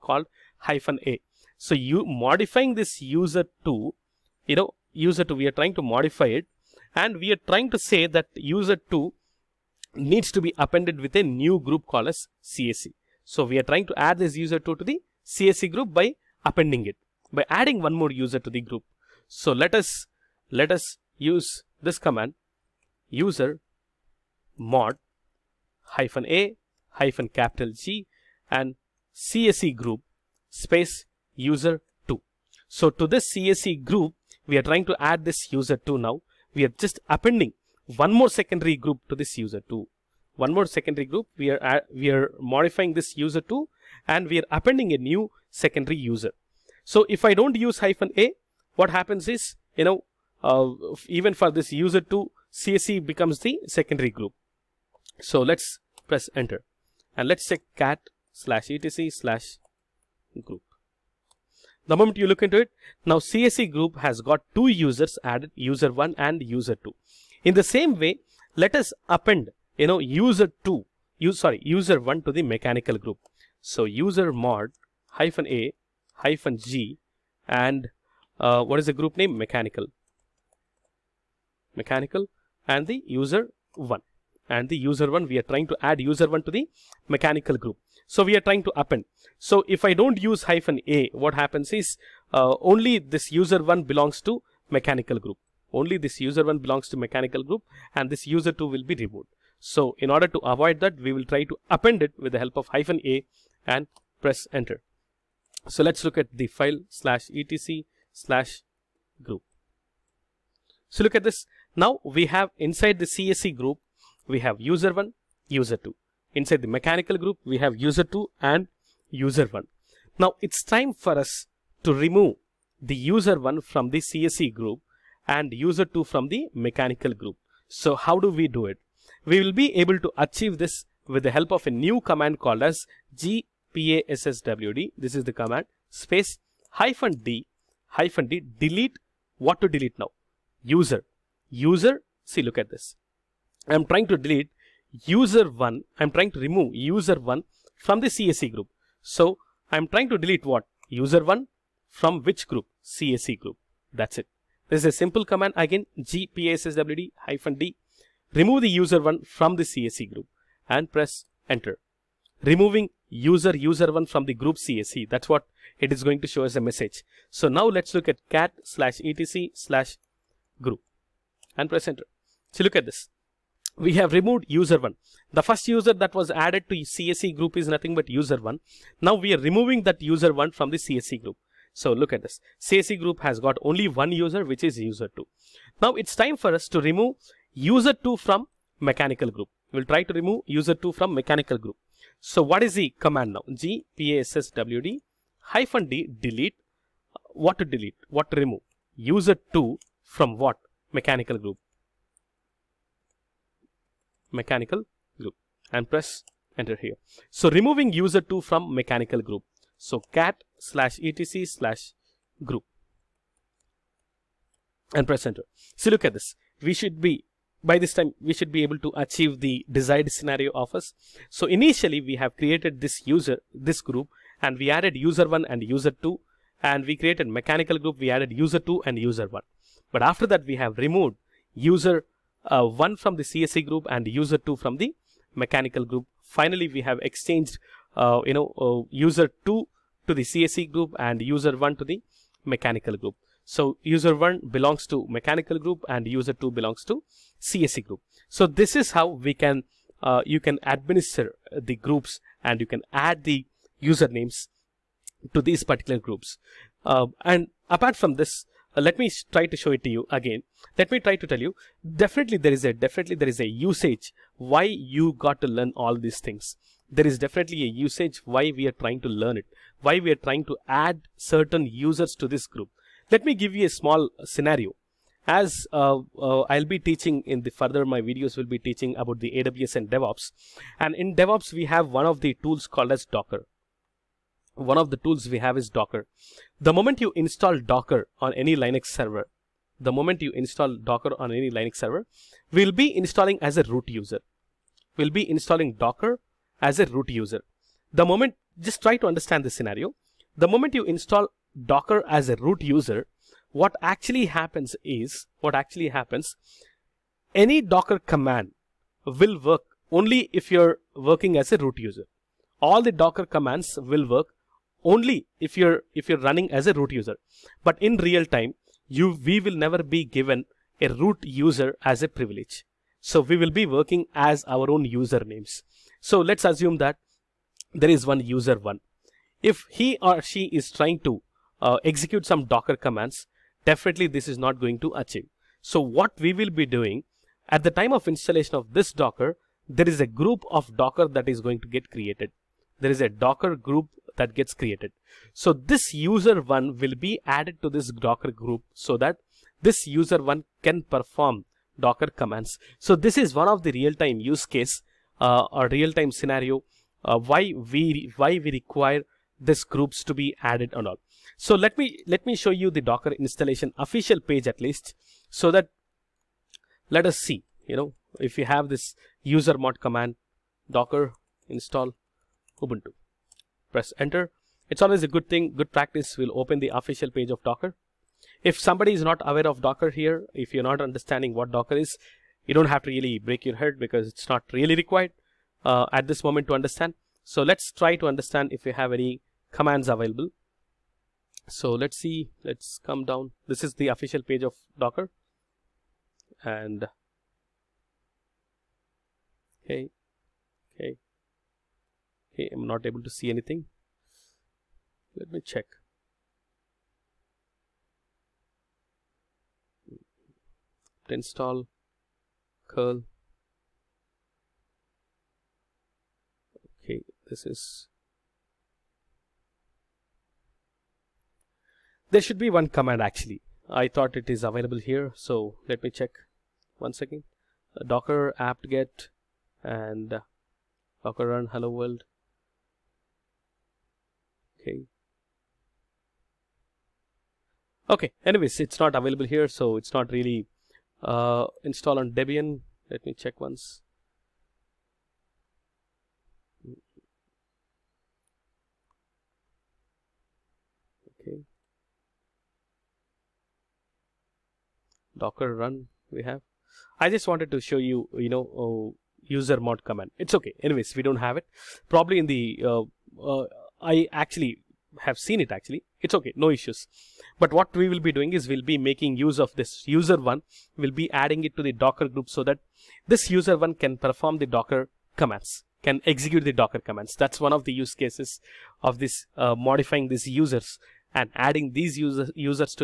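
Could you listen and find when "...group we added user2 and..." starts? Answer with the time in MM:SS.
03:47.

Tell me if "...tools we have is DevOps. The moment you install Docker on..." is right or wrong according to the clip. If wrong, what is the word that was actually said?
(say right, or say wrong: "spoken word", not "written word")
wrong: "Docker", not "DevOps".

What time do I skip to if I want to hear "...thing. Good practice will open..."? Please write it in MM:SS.
06:15.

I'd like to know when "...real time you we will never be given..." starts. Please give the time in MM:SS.
05:18.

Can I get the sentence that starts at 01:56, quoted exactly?
Inside the mechanical group, we have user2 and user1.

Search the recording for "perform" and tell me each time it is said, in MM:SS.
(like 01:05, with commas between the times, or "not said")
05:50, 07:53.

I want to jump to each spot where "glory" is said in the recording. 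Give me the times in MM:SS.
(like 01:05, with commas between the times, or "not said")
not said.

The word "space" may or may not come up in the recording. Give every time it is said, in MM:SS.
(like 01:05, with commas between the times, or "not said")
00:30, 02:15.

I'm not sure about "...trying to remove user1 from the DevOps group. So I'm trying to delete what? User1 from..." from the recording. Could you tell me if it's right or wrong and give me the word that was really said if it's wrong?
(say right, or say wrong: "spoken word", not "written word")
wrong: "CSE", not "DevOps".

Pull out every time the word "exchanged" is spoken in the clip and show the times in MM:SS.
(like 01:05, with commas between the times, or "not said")
03:57.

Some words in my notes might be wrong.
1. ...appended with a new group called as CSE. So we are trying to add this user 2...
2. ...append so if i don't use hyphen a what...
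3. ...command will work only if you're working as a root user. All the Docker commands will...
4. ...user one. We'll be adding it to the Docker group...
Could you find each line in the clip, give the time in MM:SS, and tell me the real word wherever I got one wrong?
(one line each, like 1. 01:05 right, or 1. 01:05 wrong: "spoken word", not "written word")
1. 00:10 right
2. 01:28 right
3. 05:07 right
4. 07:49 right.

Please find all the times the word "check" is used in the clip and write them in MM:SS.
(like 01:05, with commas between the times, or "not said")
00:57, 06:45, 07:05, 07:23.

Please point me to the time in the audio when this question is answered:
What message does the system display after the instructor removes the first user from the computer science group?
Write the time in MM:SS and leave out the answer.
02:42.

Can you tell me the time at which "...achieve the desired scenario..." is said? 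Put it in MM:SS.
03:38.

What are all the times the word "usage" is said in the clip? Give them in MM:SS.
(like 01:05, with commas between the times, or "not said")
04:23, 04:27.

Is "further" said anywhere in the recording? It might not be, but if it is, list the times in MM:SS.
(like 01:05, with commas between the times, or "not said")
04:37.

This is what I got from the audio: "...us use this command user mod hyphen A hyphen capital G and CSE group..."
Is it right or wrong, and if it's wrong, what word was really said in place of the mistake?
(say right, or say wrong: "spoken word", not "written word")
right.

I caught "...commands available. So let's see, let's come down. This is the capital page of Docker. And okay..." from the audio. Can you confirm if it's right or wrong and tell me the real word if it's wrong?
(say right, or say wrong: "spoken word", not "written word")
wrong: "official", not "capital".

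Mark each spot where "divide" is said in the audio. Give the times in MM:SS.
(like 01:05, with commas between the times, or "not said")
not said.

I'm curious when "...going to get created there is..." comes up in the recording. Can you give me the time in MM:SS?
05:41.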